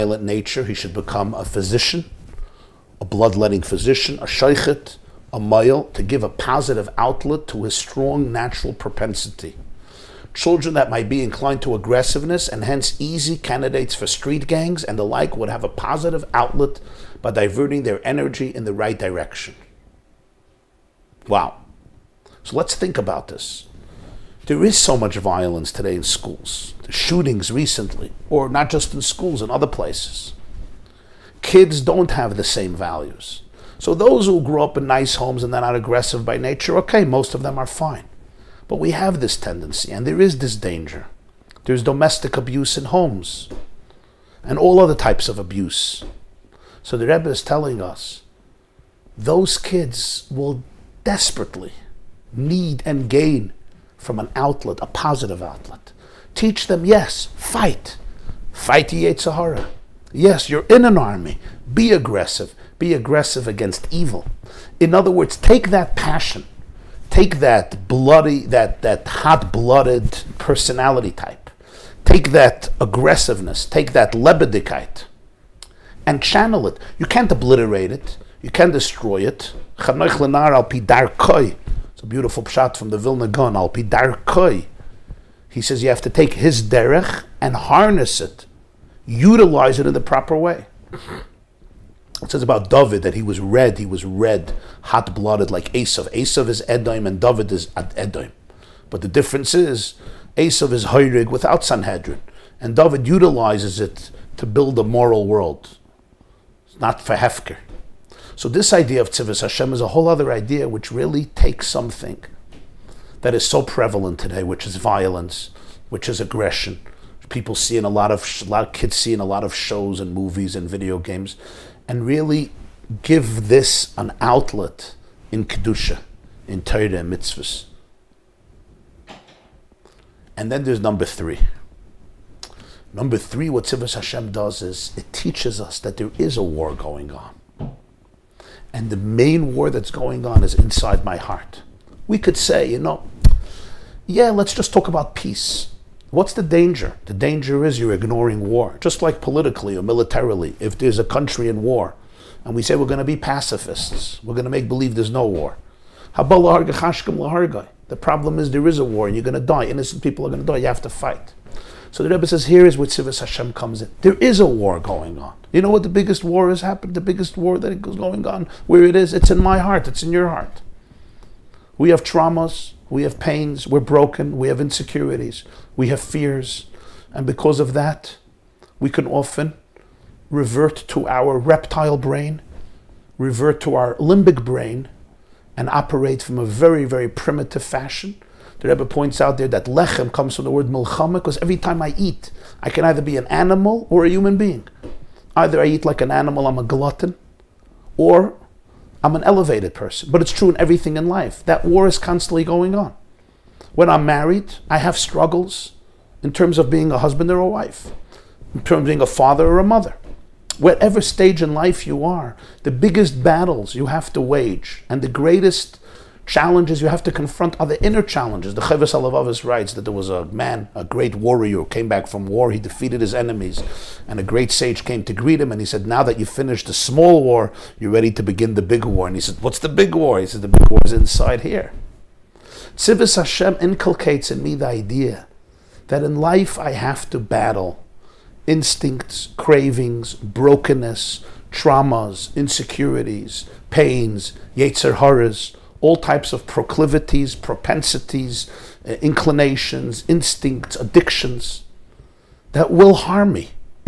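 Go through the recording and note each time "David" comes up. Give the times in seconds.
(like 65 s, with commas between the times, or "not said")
92 s, 97 s, 102 s.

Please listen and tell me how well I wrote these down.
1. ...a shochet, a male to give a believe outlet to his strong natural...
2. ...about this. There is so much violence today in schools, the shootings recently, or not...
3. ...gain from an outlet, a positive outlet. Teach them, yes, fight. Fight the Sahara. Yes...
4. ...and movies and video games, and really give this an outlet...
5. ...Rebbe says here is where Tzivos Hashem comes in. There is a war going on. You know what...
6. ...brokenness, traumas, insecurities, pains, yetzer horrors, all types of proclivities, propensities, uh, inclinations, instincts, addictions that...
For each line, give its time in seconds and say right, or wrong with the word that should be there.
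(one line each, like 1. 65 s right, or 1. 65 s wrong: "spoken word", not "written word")
1. 4 s wrong: "positive", not "believe"
2. 22 s right
3. 53 s right
4. 119 s right
5. 162 s right
6. 240 s right.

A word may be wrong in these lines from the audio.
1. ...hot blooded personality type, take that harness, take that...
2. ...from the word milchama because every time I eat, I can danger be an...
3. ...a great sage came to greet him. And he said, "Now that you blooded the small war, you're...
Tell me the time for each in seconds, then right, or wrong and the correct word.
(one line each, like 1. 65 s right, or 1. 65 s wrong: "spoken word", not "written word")
1. 69 s wrong: "aggressiveness", not "harness"
2. 190 s wrong: "either", not "danger"
3. 224 s wrong: "finished", not "blooded".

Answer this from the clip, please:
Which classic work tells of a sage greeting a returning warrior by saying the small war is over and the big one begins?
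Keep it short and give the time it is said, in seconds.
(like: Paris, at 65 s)
Chovos HaLevavos, at 218 s.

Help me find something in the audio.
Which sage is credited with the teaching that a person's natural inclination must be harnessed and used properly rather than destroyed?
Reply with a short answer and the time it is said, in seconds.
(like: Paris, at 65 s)
Vilna Gaon, at 82 s.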